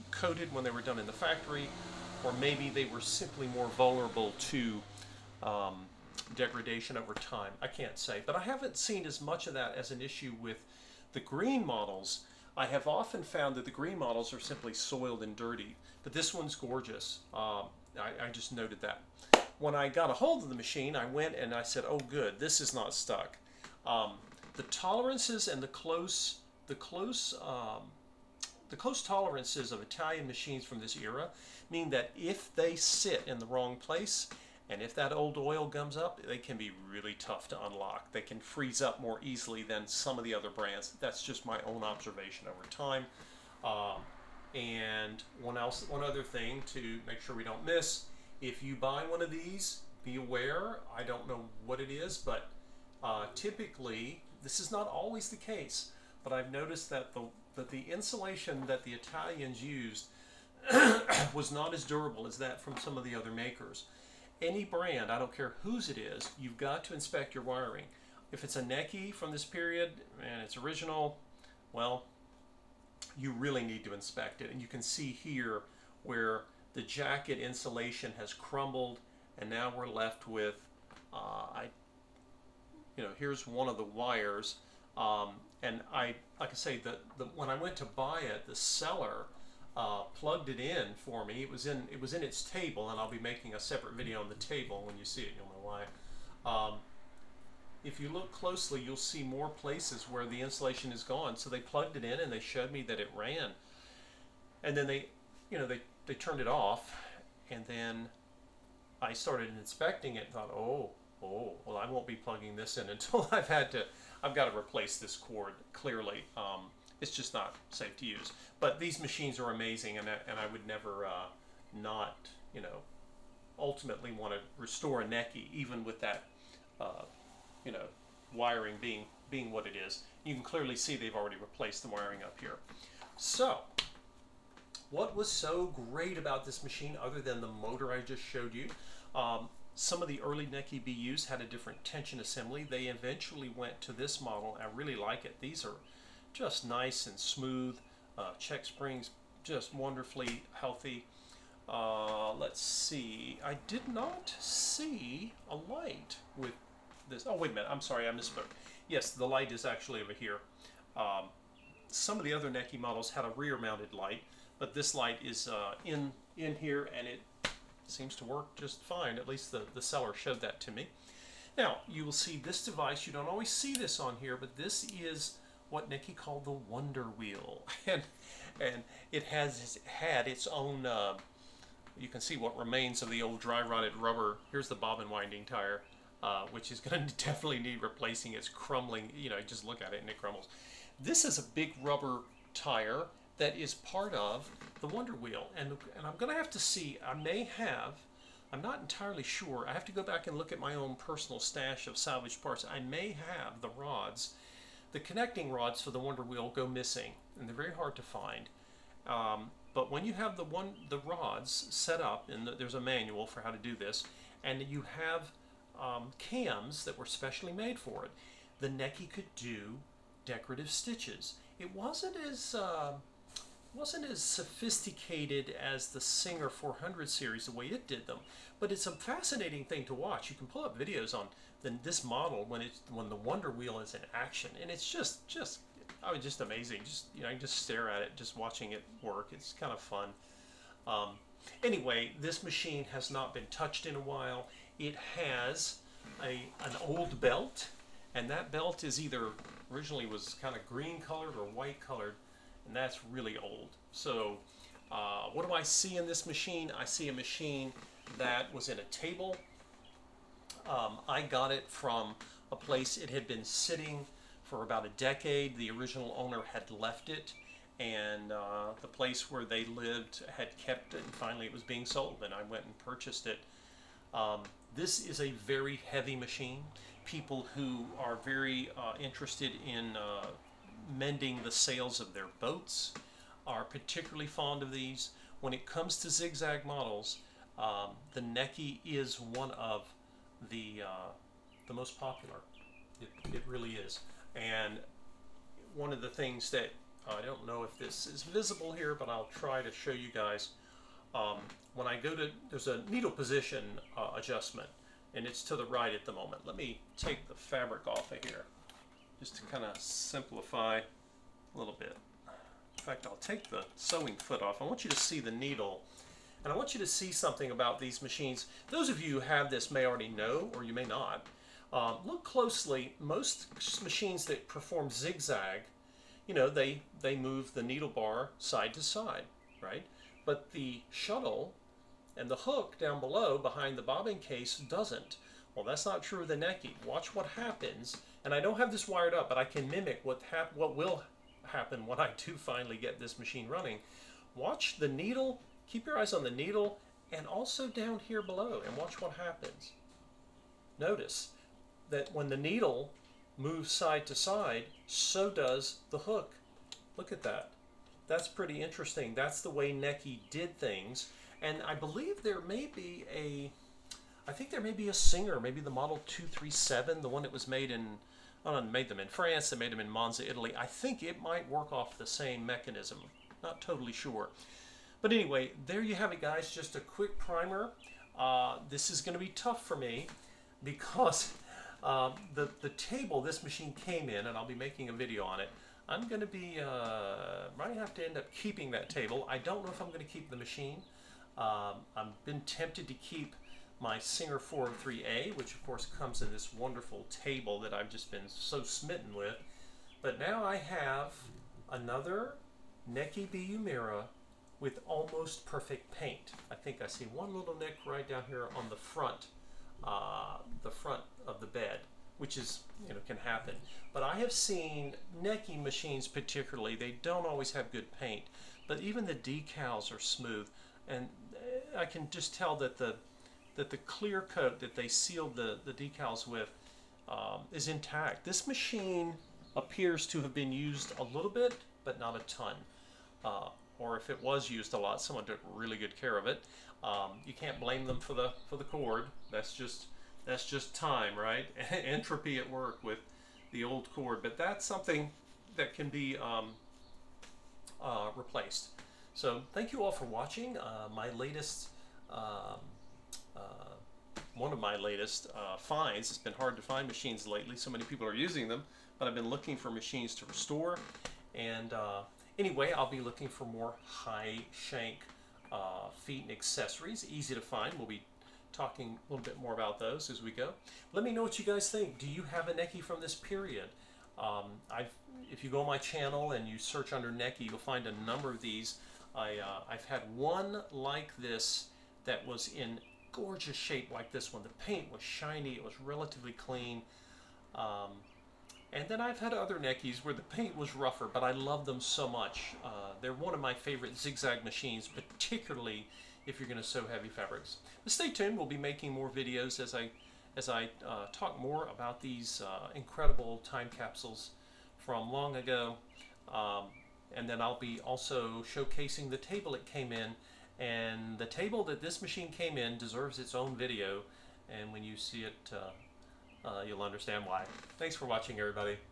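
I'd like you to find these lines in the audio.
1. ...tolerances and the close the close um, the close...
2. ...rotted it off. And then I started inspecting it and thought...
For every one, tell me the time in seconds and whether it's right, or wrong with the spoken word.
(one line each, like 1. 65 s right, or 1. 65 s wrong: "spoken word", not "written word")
1. 24 s right
2. 106 s wrong: "turned", not "rotted".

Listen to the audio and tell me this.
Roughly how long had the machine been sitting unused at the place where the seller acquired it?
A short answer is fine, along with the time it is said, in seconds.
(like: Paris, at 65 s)
About a decade, at 264 s.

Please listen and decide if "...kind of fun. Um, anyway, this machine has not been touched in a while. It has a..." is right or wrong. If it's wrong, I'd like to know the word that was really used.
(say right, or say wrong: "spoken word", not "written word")
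right.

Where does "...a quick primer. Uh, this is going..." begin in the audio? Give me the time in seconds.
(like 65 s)
376 s.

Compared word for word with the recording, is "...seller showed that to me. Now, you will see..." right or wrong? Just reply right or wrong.
right.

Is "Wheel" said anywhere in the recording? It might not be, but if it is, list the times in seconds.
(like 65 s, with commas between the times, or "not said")
177 s, 195 s, 206 s, 233 s.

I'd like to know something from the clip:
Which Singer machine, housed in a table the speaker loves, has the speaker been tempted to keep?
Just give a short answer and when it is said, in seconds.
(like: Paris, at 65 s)
Singer 403A, at 393 s.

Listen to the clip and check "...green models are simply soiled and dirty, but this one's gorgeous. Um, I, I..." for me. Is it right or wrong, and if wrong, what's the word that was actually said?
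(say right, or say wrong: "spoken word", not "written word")
right.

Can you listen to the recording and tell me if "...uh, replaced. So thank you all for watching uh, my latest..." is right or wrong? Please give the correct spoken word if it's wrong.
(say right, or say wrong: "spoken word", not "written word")
right.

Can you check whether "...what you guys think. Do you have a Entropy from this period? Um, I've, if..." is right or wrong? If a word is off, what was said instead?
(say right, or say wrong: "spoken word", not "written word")
wrong: "Necchi", not "Entropy".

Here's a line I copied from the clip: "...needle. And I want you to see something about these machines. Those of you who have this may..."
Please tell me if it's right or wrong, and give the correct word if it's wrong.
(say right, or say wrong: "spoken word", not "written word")
right.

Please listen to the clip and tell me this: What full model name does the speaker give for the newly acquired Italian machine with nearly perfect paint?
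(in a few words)
Necchi BU Mira.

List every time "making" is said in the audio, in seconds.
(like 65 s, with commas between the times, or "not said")
93 s, 384 s, 498 s.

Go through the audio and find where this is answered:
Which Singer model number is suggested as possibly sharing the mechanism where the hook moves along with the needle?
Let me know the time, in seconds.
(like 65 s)
365 s.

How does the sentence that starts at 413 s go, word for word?
But I have seen Necchi machines particularly, they don't always have good paint, but even the decals are smooth.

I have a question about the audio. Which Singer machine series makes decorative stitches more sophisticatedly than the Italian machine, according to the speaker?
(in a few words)
Singer 400 series.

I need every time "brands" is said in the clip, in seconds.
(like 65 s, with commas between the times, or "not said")
40 s, 64 s.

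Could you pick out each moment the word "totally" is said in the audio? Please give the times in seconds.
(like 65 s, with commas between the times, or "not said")
373 s.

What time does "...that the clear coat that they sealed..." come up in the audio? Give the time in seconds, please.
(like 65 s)
423 s.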